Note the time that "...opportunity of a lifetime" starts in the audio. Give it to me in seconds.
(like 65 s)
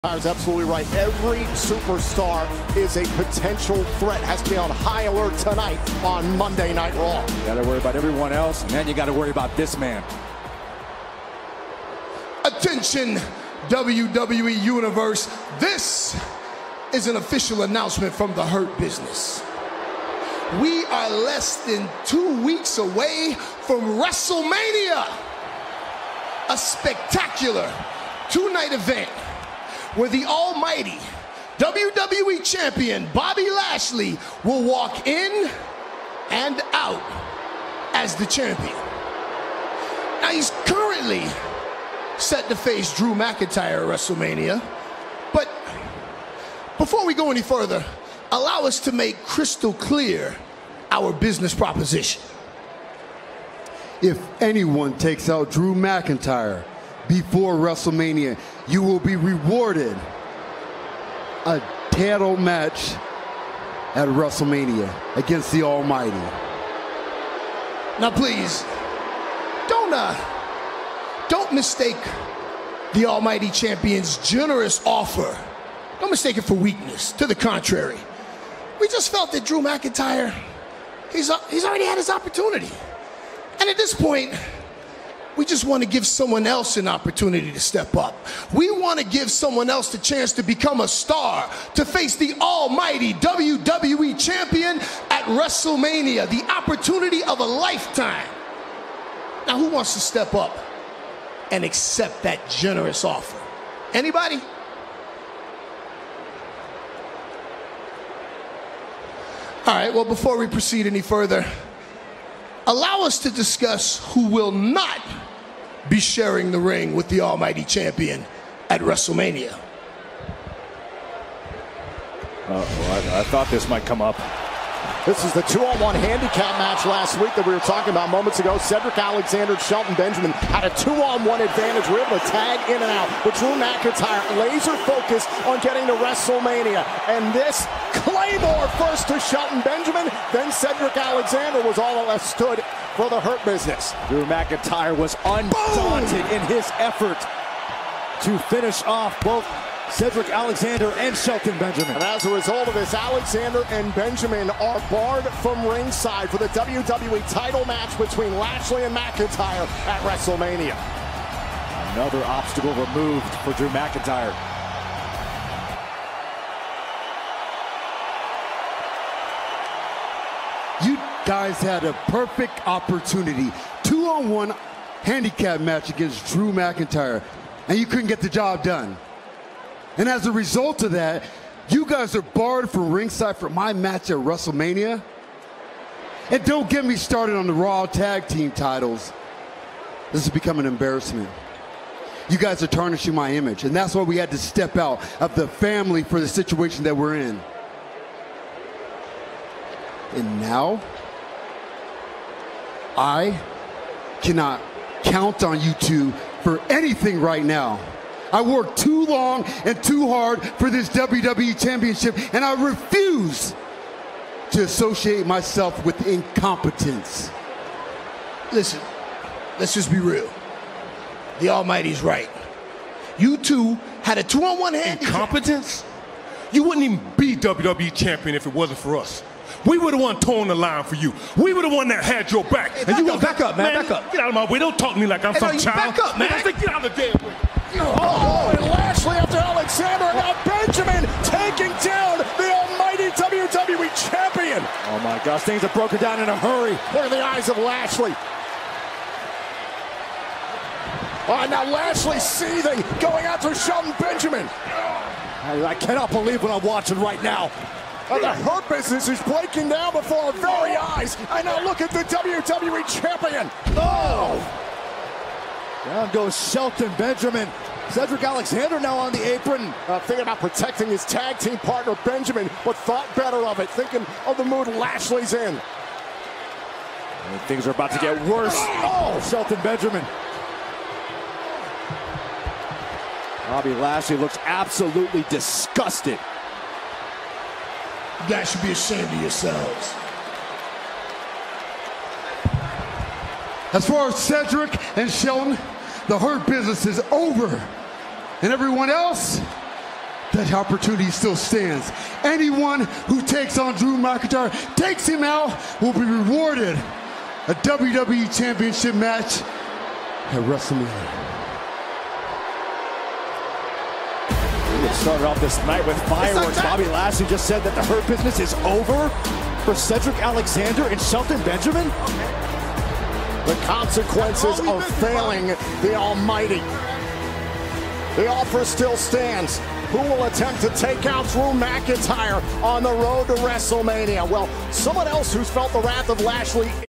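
96 s.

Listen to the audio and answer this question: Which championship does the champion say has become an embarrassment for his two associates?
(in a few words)
Raw Tag Team titles.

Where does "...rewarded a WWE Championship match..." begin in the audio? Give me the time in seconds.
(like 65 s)
306 s.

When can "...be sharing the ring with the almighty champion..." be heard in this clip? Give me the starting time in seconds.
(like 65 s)
115 s.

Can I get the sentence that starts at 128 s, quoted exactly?
Cedric Alexander, Shelton Benjamin had a two-on-one advantage.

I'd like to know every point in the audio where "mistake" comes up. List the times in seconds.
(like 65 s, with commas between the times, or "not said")
71 s, 76 s.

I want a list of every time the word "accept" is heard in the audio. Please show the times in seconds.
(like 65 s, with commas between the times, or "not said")
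101 s.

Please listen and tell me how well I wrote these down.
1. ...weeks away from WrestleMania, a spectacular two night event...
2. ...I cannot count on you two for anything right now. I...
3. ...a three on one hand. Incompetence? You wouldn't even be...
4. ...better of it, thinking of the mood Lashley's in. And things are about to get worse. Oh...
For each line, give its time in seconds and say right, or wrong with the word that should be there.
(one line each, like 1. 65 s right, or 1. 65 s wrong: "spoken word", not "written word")
1. 22 s right
2. 202 s right
3. 224 s wrong: "two", not "three"
4. 273 s right.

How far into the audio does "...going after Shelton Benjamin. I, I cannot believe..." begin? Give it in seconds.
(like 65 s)
252 s.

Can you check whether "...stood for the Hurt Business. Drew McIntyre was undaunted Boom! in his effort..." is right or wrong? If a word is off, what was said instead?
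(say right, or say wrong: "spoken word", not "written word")
right.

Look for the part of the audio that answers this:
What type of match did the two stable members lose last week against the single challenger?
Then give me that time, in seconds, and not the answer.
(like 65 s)
125 s.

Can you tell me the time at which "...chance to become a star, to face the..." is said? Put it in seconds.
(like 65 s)
89 s.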